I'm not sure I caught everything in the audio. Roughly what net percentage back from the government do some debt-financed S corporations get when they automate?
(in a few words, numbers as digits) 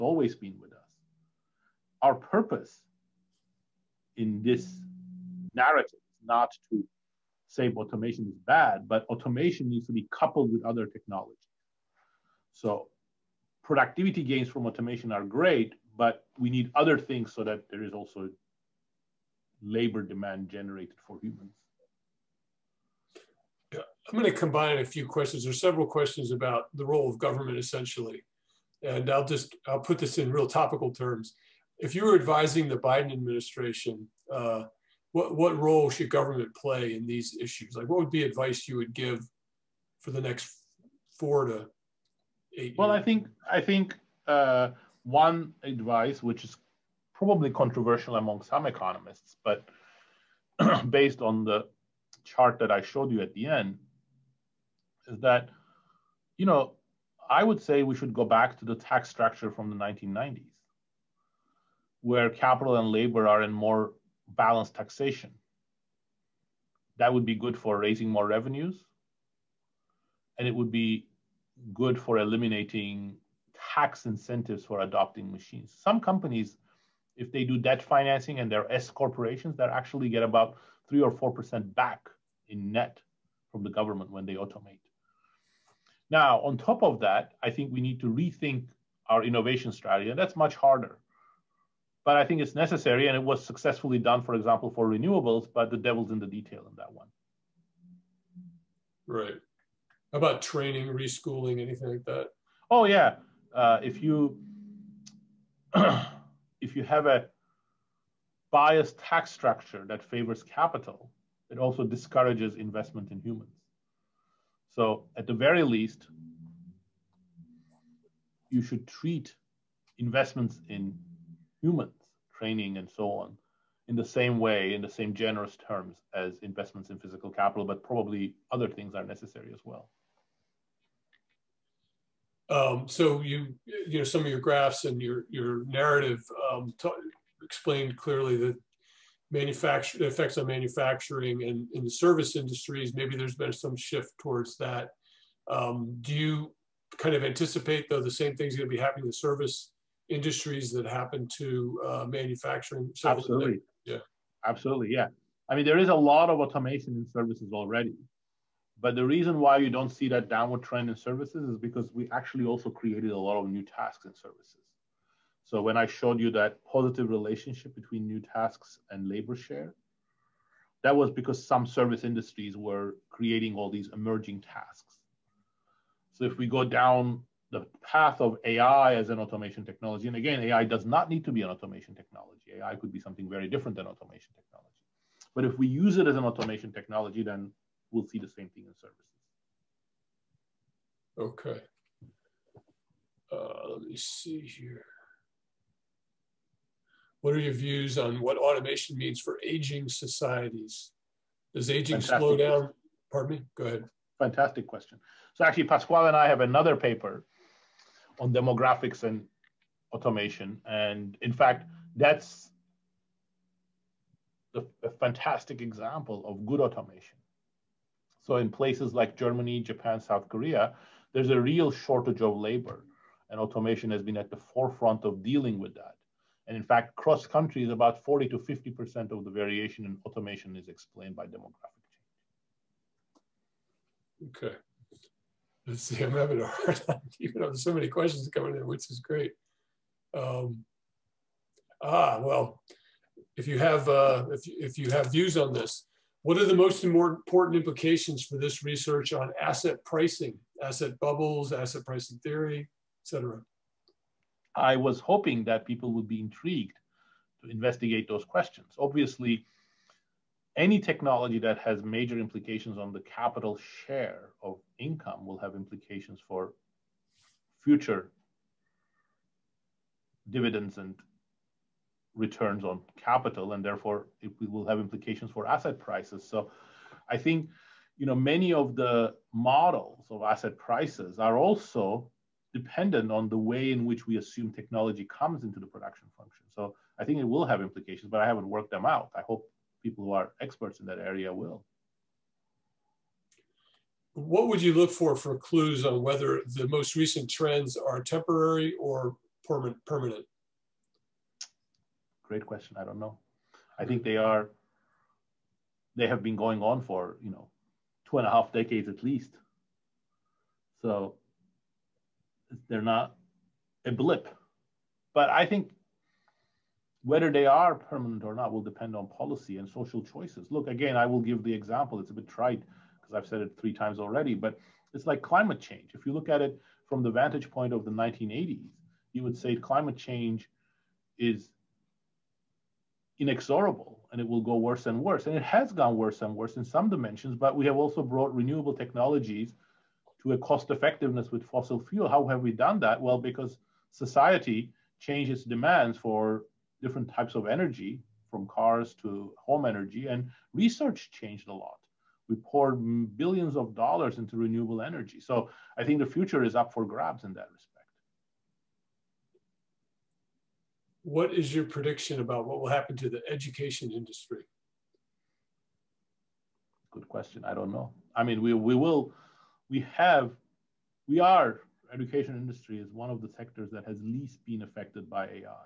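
3 or 4 percent.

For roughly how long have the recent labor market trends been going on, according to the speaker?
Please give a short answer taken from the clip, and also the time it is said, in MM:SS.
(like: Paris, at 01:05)
2.5 decades, at 05:08.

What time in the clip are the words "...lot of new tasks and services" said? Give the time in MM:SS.
02:43.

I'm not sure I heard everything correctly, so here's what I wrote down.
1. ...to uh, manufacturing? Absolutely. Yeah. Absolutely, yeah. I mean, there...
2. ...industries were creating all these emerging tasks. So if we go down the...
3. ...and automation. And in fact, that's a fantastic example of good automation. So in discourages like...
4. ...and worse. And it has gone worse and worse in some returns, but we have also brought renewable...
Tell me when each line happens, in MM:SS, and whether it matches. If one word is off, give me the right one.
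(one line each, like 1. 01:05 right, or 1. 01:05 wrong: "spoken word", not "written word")
1. 02:31 right
2. 02:52 right
3. 03:29 wrong: "places", not "discourages"
4. 05:34 wrong: "dimensions", not "returns".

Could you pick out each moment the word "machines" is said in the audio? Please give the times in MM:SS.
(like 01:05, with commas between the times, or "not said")
01:15.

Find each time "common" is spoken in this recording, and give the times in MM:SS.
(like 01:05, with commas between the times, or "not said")
not said.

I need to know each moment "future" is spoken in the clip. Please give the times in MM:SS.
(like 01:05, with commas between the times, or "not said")
04:27, 05:56.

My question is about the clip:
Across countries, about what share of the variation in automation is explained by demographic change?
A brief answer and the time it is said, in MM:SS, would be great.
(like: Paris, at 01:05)
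40 to 50%, at 03:48.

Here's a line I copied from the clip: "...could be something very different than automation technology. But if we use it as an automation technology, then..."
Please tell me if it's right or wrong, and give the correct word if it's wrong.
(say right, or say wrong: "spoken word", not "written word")
right.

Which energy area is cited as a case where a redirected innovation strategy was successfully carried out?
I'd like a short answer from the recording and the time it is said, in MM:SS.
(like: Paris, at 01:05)
Renewables, at 01:34.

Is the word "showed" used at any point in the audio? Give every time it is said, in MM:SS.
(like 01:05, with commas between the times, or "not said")
00:52, 02:45.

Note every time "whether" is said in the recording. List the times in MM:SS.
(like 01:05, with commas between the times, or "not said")
04:56, 05:17.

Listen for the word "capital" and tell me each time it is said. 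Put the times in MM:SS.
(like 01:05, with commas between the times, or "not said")
01:02, 01:50, 02:07, 04:22, 04:33.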